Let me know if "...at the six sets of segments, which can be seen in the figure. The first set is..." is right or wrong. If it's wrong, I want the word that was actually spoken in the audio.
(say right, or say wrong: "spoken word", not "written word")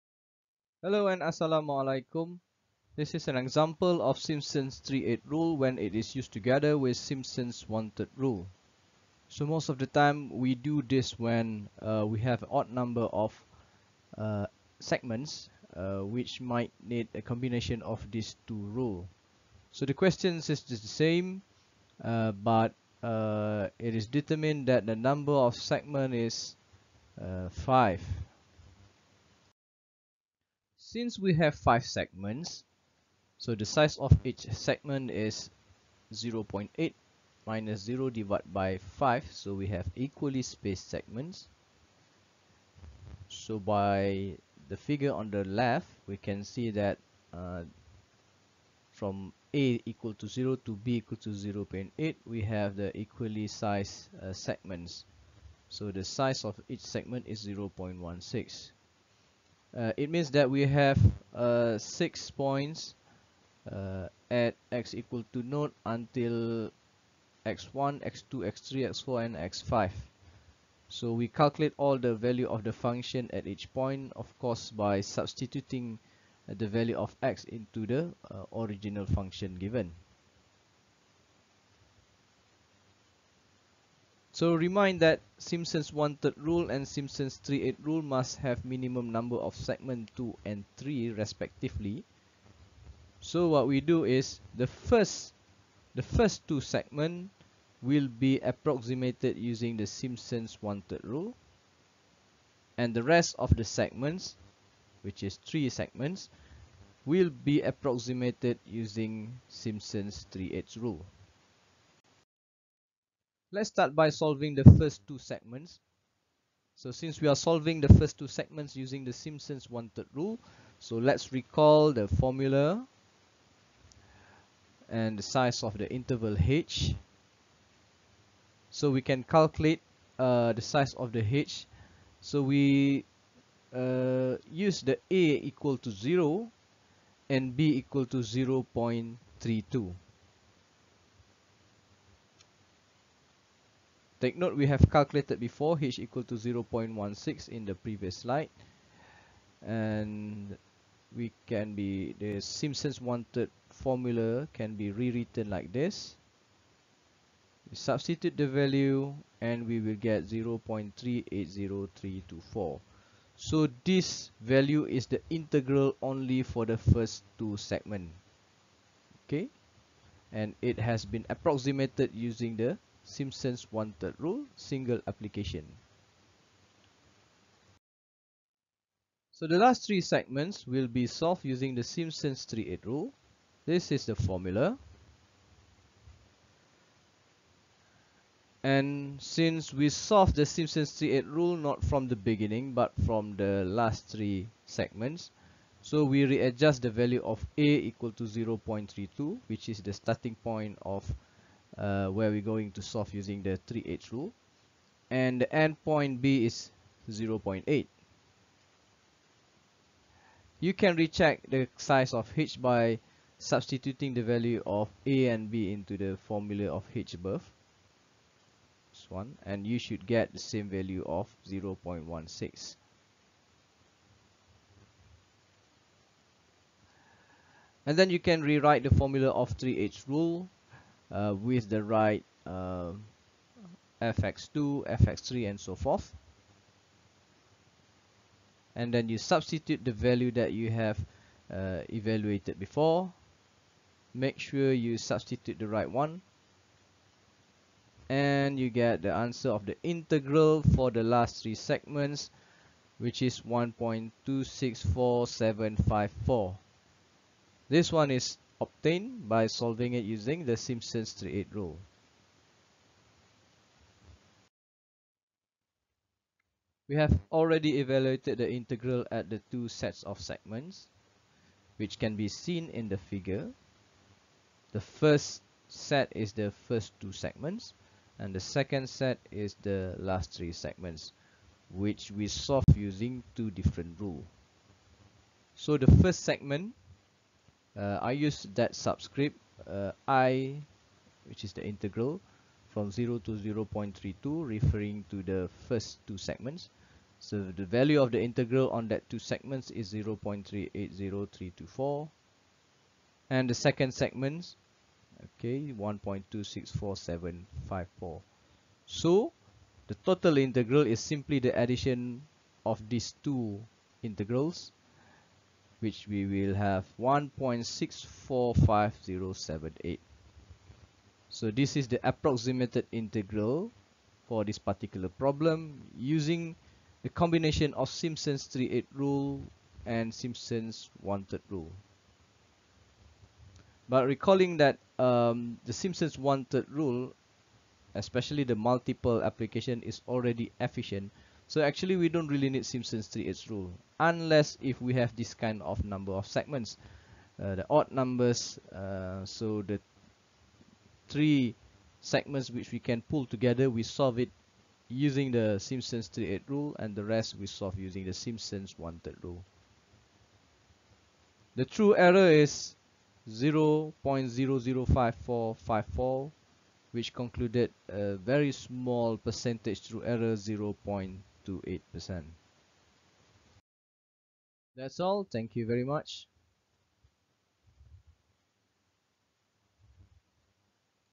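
wrong: "two", not "six".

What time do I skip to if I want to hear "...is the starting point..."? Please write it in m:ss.
3:19.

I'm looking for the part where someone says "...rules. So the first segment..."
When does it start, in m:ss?
4:43.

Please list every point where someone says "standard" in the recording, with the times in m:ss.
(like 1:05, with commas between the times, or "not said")
not said.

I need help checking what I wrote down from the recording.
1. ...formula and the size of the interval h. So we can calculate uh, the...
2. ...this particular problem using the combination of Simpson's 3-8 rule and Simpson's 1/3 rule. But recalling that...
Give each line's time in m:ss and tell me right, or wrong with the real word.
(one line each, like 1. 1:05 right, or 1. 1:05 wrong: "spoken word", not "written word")
1. 2:02 right
2. 5:24 right.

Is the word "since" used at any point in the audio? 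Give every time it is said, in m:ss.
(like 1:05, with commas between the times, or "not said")
0:30, 1:56, 3:09.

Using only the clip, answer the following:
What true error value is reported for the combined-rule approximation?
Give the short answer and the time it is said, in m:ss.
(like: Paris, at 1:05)
0.005454, at 6:03.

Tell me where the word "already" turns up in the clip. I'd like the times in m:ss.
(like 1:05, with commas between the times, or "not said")
4:27, 5:40.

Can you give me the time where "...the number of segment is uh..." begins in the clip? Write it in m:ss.
0:24.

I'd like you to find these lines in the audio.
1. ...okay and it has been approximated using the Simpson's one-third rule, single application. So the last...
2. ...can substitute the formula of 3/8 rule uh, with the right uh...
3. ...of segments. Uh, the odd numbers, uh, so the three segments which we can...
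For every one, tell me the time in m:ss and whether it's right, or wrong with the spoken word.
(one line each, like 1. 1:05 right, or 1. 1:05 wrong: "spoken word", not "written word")
1. 2:49 right
2. 3:48 wrong: "rewrite", not "substitute"
3. 5:46 right.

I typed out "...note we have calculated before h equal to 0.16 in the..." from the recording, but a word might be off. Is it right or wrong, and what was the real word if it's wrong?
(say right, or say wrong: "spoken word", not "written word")
right.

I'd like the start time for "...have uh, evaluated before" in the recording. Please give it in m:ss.
4:00.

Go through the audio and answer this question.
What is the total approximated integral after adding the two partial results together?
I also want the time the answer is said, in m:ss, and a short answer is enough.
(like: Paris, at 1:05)
1.645078, at 5:17.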